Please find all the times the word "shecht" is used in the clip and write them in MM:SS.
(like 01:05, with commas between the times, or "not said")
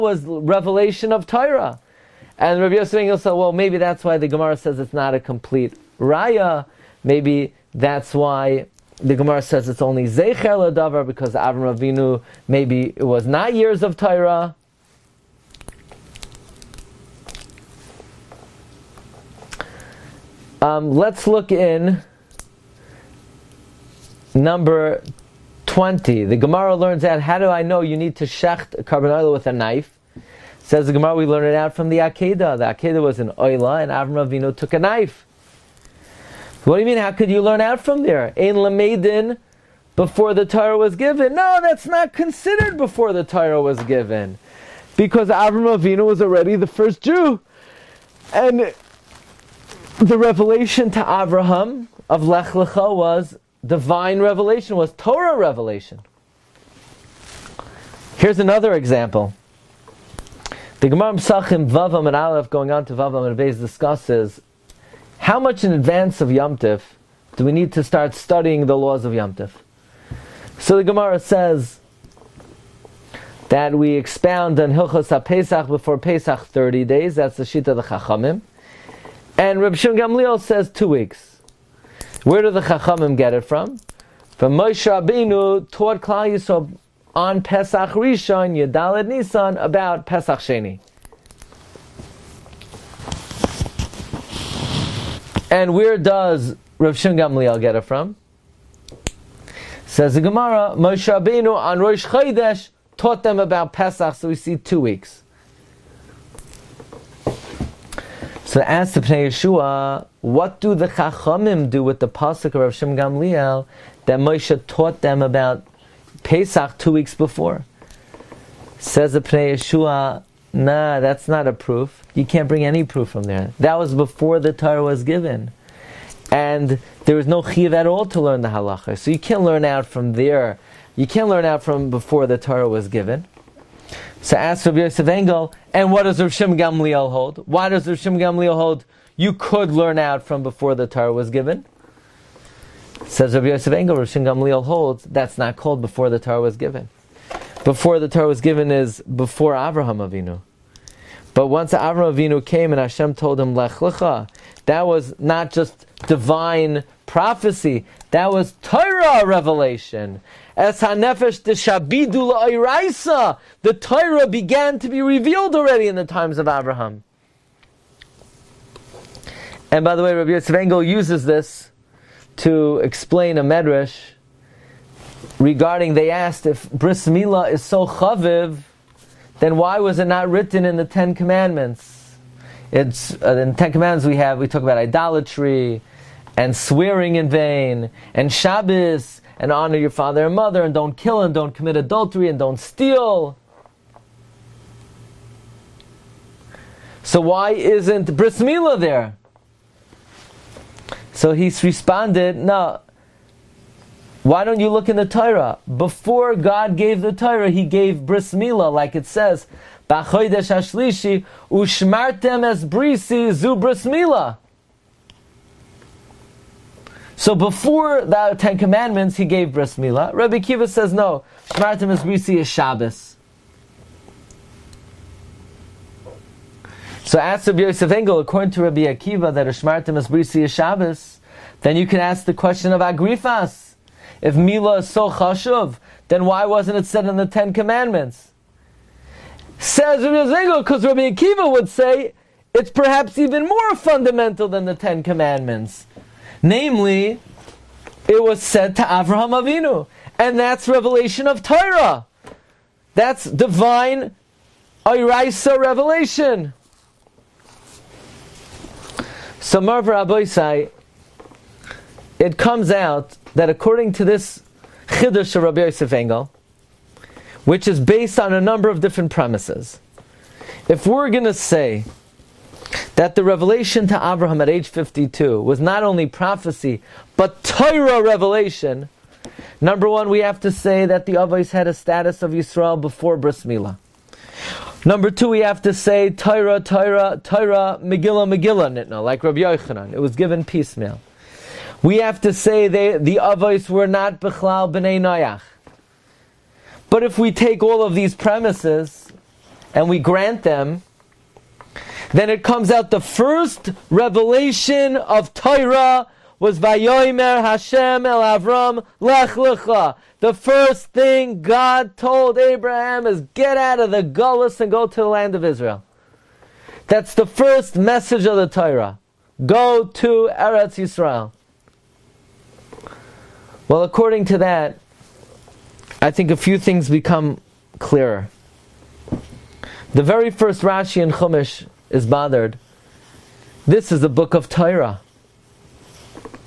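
00:28.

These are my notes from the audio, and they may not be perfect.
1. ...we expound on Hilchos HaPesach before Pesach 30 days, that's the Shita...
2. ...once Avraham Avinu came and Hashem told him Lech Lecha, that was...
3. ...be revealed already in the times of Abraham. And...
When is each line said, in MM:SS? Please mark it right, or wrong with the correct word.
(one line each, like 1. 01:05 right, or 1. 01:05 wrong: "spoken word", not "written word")
1. 01:13 right
2. 02:31 right
3. 02:44 right.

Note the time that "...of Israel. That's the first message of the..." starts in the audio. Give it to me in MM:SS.
05:15.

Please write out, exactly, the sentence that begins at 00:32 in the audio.
The Akedah was an oila, and Avram Avinu took a knife.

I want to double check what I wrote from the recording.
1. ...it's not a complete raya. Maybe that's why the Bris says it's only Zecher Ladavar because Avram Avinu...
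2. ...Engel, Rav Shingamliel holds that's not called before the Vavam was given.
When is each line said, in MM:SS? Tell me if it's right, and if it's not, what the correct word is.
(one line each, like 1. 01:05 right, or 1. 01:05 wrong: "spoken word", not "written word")
1. 00:04 wrong: "Gemara", not "Bris"
2. 02:23 wrong: "Torah", not "Vavam".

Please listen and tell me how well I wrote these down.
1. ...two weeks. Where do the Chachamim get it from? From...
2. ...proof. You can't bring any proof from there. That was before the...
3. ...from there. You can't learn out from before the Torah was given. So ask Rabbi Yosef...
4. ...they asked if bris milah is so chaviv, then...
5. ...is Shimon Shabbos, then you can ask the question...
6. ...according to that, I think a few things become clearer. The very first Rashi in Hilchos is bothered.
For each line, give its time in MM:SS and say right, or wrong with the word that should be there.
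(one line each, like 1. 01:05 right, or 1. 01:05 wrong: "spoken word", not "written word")
1. 01:20 right
2. 02:01 right
3. 02:09 right
4. 02:55 right
5. 03:49 wrong: "Brisi", not "Shimon"
6. 05:23 wrong: "Chumash", not "Hilchos".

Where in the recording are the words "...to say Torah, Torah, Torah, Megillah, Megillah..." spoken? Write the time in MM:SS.
04:45.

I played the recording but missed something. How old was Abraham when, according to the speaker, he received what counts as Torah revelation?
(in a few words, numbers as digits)
52.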